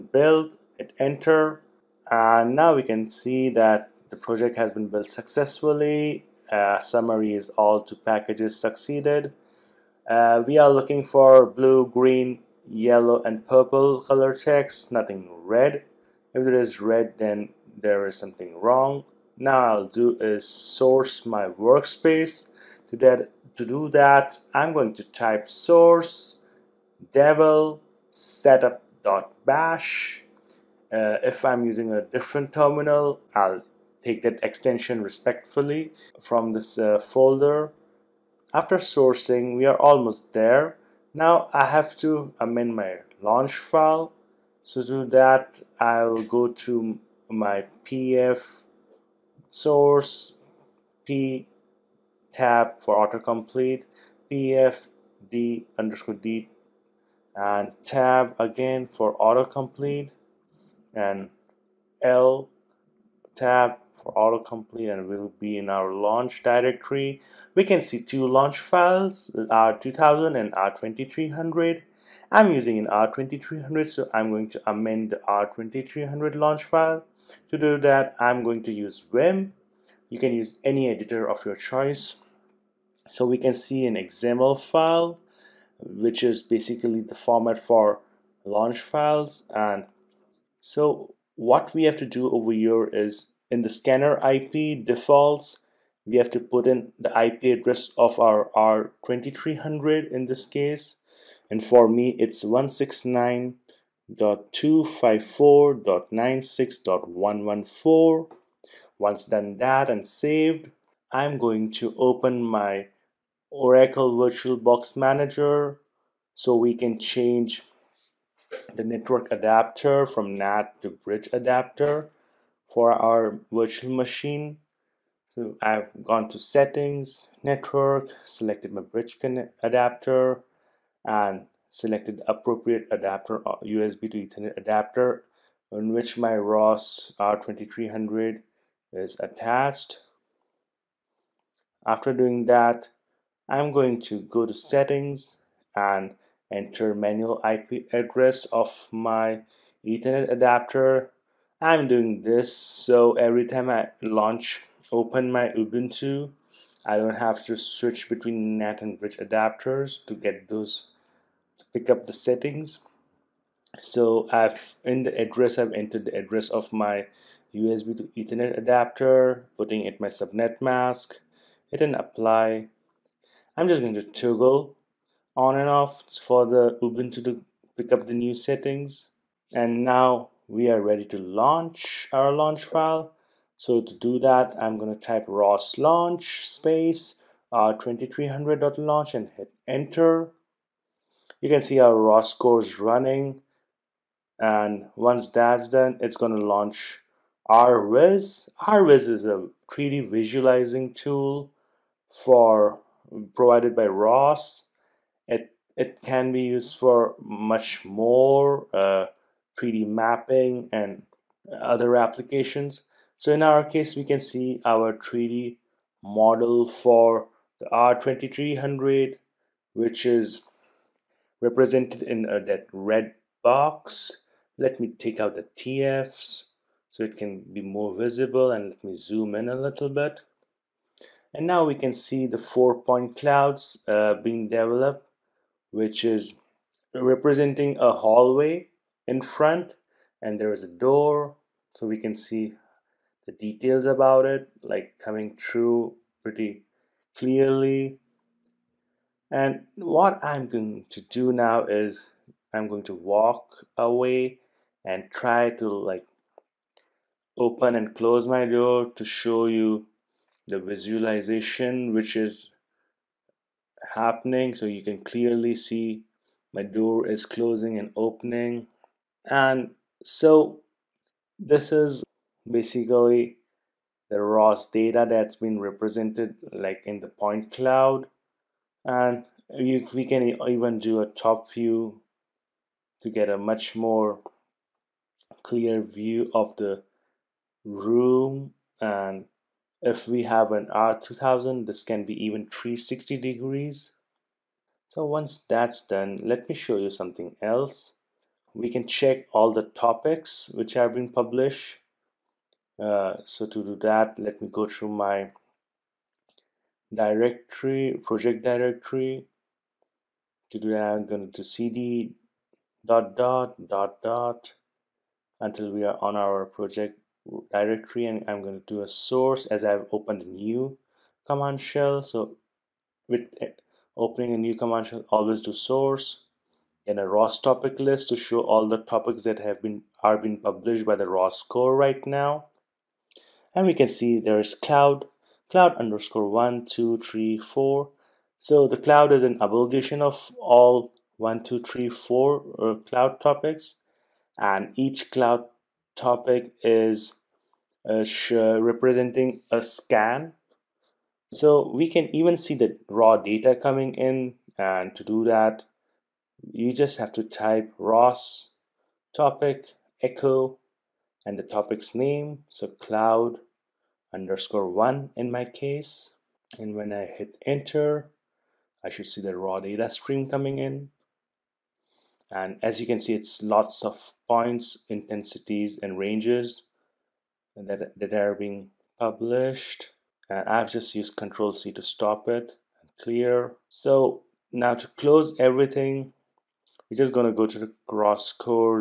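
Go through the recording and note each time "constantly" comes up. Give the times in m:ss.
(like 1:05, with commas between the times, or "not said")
not said.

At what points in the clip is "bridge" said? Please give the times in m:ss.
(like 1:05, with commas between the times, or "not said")
2:01, 2:08, 2:38.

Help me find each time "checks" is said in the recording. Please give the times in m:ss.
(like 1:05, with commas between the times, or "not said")
0:14, 4:58.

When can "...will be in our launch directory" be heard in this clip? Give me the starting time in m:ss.
1:05.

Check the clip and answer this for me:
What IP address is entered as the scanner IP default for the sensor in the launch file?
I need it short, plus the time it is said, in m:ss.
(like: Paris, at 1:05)
169.254.96.114, at 1:42.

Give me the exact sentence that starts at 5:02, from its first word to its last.
Uh, so to do that, let me go through my directory, project directory.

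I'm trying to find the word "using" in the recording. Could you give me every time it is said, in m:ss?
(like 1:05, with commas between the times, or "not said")
0:31, 1:12.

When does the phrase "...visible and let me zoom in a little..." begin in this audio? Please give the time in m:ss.
3:47.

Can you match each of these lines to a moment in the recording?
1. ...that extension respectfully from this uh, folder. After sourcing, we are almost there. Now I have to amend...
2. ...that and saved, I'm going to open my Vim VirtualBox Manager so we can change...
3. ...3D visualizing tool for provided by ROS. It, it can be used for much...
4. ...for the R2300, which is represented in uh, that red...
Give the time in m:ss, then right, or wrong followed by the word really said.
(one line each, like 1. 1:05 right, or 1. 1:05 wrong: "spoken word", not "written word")
1. 0:34 right
2. 1:49 wrong: "Oracle", not "Vim"
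3. 3:19 right
4. 3:36 right.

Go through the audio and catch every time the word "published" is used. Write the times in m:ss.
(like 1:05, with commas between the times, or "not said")
5:01, 5:30, 6:18.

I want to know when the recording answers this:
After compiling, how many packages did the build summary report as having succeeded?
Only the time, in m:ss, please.
0:07.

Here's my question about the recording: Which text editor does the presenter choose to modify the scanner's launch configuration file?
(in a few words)
Vim.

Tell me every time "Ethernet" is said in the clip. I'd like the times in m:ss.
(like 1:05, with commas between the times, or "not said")
2:14, 2:29, 2:48.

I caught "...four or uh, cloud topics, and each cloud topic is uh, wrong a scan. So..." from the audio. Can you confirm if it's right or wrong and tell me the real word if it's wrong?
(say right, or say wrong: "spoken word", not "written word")
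wrong: "representing", not "wrong".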